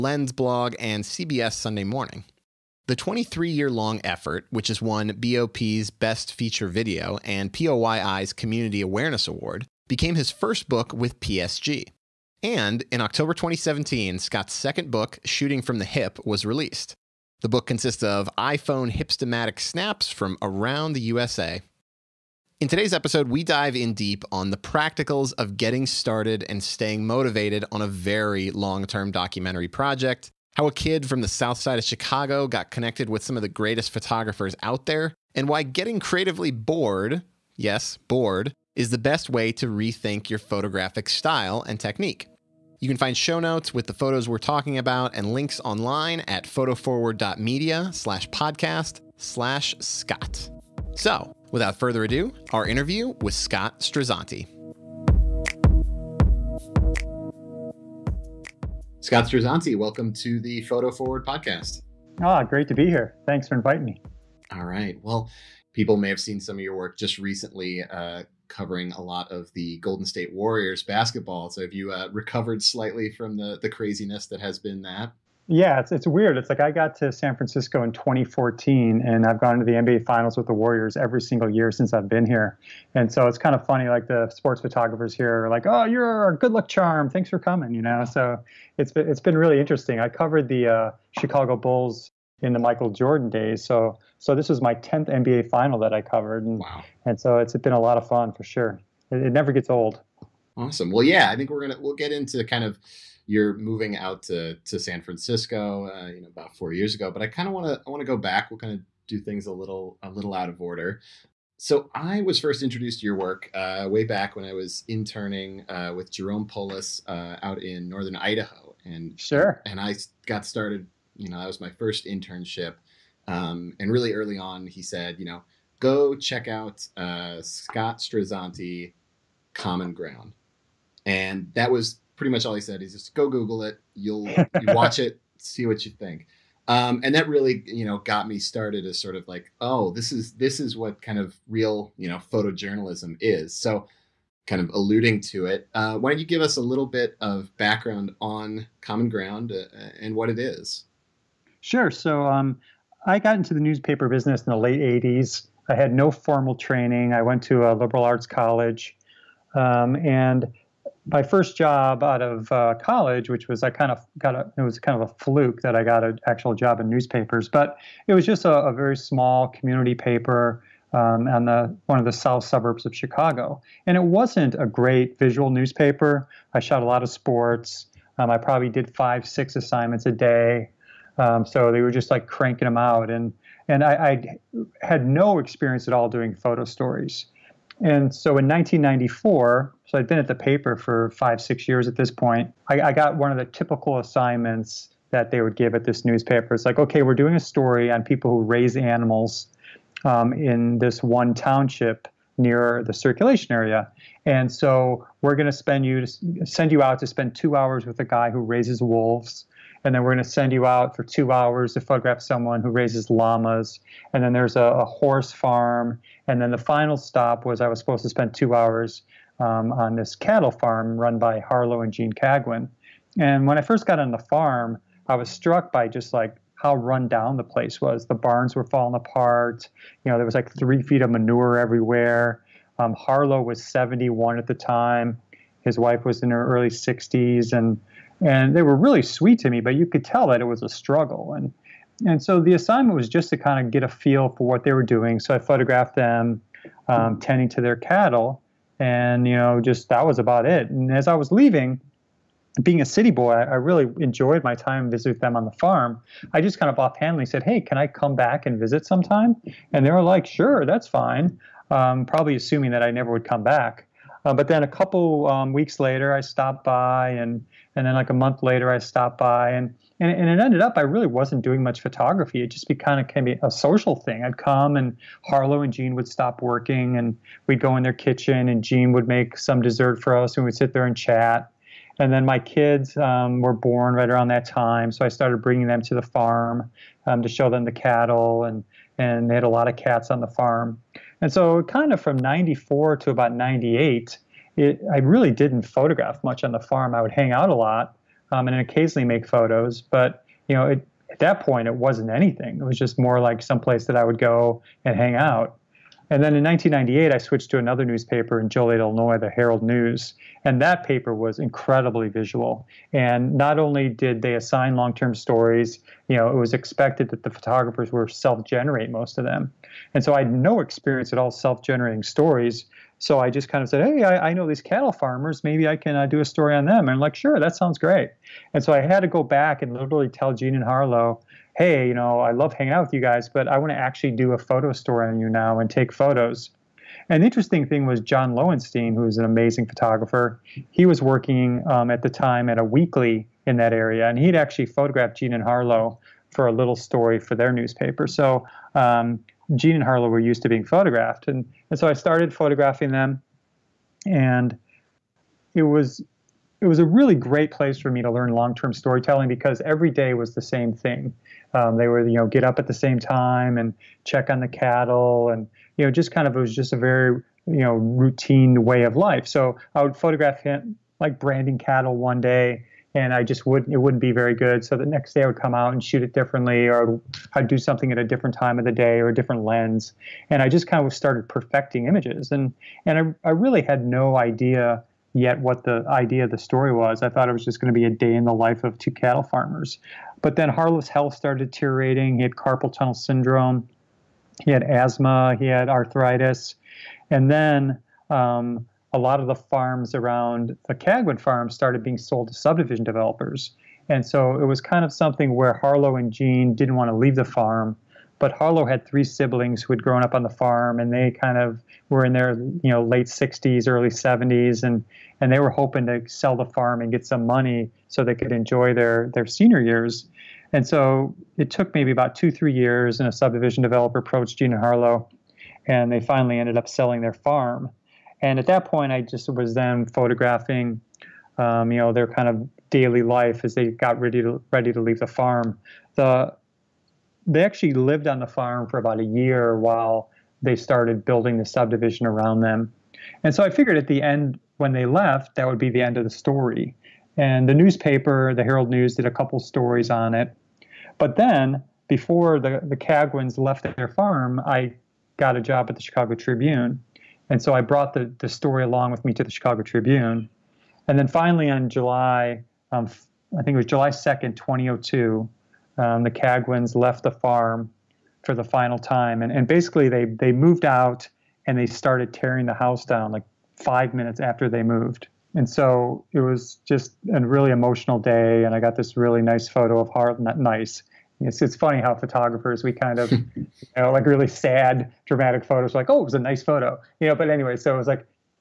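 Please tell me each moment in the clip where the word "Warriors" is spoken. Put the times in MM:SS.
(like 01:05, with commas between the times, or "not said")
01:10, 01:20.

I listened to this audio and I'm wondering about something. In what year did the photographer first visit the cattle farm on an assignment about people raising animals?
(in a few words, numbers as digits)
1994.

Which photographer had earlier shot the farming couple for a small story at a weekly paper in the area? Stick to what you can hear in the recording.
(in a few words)
Jon Lowenstein.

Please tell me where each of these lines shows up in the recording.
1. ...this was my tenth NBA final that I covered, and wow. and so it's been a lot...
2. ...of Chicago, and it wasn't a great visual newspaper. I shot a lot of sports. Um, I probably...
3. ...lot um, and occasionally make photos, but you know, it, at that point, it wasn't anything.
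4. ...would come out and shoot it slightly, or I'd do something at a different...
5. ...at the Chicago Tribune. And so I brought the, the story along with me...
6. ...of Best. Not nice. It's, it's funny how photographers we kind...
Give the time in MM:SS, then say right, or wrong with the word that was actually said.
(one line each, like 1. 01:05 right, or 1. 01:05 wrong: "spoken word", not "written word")
1. 01:34 right
2. 02:52 right
3. 04:57 right
4. 06:15 wrong: "differently", not "slightly"
5. 07:35 right
6. 07:59 wrong: "Harlan", not "Best".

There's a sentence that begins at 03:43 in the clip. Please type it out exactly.
And when I first got on the farm, I was struck by just like how run down the place was.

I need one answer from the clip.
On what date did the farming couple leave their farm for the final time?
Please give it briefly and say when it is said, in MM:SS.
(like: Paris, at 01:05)
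July 2, 2002, at 07:43.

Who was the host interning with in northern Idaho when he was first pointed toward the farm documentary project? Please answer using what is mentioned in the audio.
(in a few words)
Jerome Polis.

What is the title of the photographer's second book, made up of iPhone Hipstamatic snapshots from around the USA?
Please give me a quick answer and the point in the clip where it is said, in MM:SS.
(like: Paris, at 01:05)
Shooting from the Hip, at 00:15.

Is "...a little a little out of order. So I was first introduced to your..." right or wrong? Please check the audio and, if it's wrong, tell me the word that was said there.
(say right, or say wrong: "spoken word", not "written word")
right.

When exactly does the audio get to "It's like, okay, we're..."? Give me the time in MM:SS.
03:16.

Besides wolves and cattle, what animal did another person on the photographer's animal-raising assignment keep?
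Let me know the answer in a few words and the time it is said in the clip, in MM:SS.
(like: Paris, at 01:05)
Llamas, at 03:33.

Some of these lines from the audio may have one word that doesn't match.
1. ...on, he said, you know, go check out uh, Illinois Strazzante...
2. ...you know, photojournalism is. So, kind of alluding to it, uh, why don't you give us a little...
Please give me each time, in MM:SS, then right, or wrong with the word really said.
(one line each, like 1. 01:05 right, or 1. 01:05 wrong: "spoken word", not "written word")
1. 02:04 wrong: "Scott", not "Illinois"
2. 02:21 right.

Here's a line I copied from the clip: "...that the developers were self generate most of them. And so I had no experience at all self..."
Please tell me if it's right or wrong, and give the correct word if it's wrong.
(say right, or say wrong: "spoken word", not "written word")
wrong: "photographers", not "developers".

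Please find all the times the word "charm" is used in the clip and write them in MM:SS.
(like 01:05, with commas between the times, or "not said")
01:26.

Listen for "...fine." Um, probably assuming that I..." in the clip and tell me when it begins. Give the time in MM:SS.
04:20.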